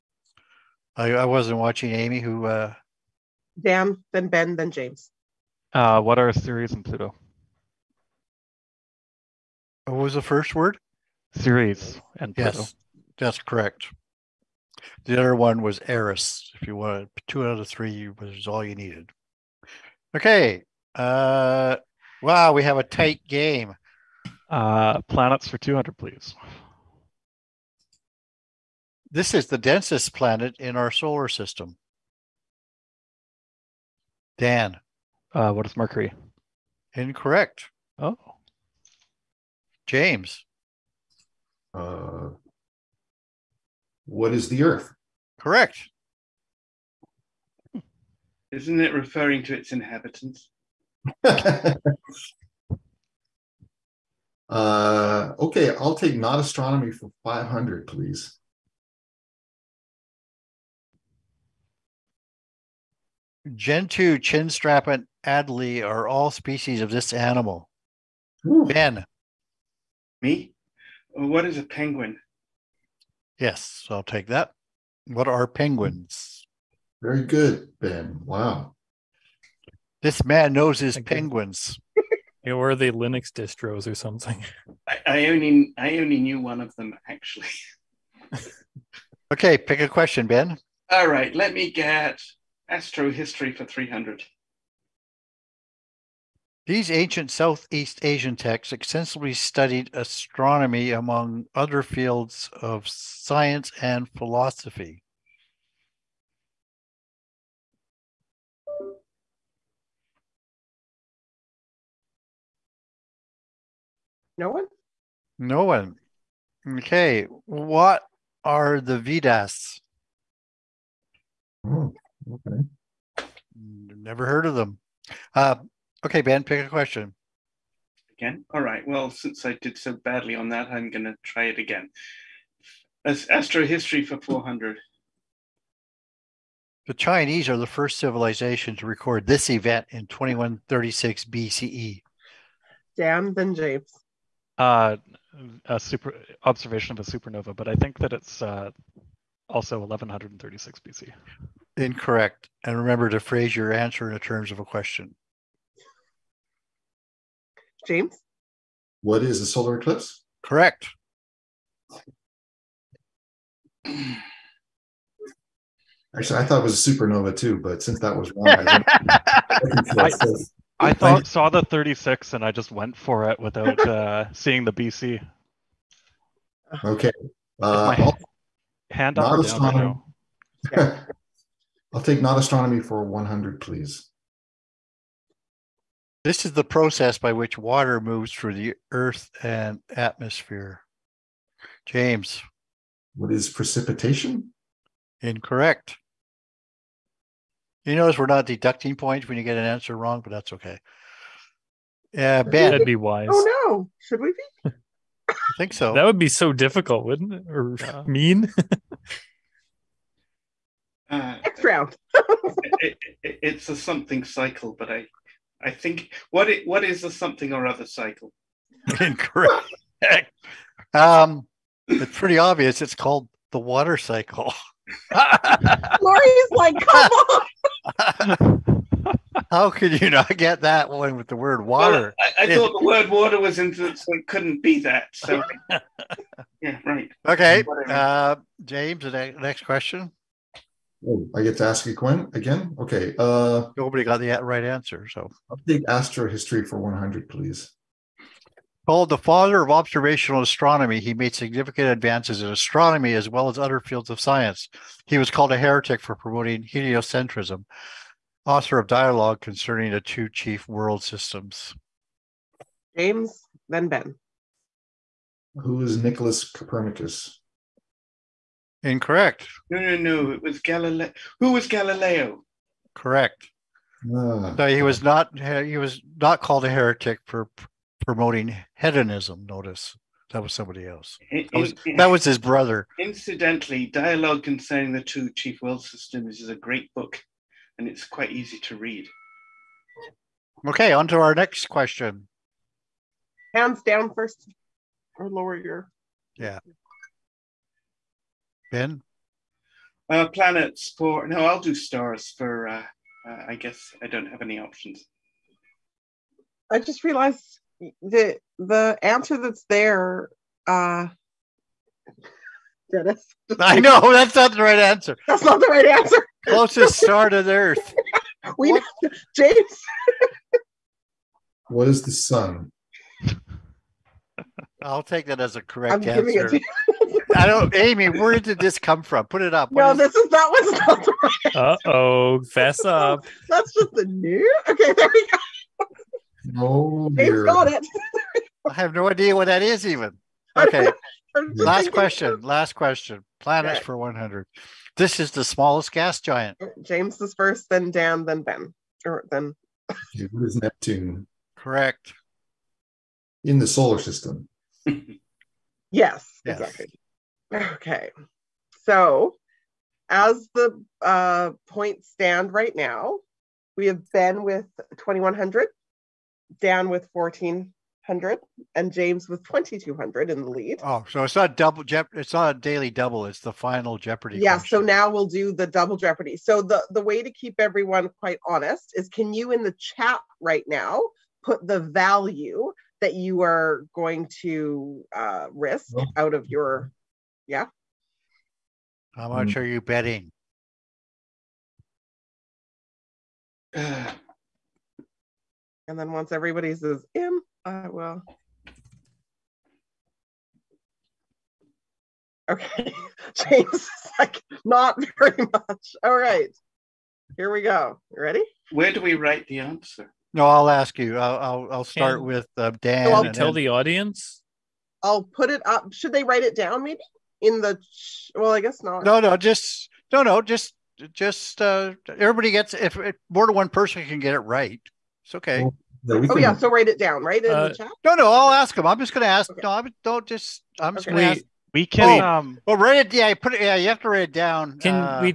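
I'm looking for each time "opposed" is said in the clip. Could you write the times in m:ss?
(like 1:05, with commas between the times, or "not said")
not said.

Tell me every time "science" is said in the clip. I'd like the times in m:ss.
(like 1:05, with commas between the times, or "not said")
1:42, 4:14.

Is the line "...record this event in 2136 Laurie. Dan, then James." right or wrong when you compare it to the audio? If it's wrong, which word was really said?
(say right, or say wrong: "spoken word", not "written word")
wrong: "BCE", not "Laurie".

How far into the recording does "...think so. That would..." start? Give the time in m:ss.
3:25.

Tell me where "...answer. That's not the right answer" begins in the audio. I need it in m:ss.
5:14.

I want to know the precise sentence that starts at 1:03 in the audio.
Gentoo, chinstrap, and Adélie are all species of this animal.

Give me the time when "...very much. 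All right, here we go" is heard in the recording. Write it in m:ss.
6:45.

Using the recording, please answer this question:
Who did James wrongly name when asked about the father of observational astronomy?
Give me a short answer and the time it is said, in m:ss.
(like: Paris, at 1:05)
Nicholas Copernicus, at 4:26.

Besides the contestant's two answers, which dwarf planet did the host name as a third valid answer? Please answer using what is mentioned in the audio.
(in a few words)
Eris.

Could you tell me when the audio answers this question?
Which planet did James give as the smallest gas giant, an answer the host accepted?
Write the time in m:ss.
5:50.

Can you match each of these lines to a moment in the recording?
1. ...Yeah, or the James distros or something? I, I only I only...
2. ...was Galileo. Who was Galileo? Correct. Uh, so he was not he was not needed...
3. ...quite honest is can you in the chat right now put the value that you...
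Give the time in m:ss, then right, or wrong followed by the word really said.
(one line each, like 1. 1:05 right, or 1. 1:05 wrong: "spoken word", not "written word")
1. 1:22 wrong: "Linux", not "James"
2. 4:30 wrong: "called", not "needed"
3. 6:18 right.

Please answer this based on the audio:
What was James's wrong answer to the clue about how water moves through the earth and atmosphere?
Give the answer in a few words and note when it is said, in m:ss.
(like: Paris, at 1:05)
Precipitation, at 3:13.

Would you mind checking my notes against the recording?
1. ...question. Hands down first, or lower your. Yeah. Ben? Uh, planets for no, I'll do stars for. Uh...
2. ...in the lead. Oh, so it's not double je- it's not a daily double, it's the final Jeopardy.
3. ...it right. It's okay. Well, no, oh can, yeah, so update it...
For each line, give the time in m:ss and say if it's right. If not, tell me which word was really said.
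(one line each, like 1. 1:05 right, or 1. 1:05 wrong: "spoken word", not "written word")
1. 4:51 right
2. 6:10 right
3. 7:04 wrong: "write", not "update".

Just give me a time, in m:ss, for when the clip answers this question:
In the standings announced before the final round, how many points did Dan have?
6:07.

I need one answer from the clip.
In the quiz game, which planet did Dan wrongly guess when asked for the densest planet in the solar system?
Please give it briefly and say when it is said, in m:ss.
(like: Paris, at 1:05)
Mercury, at 0:35.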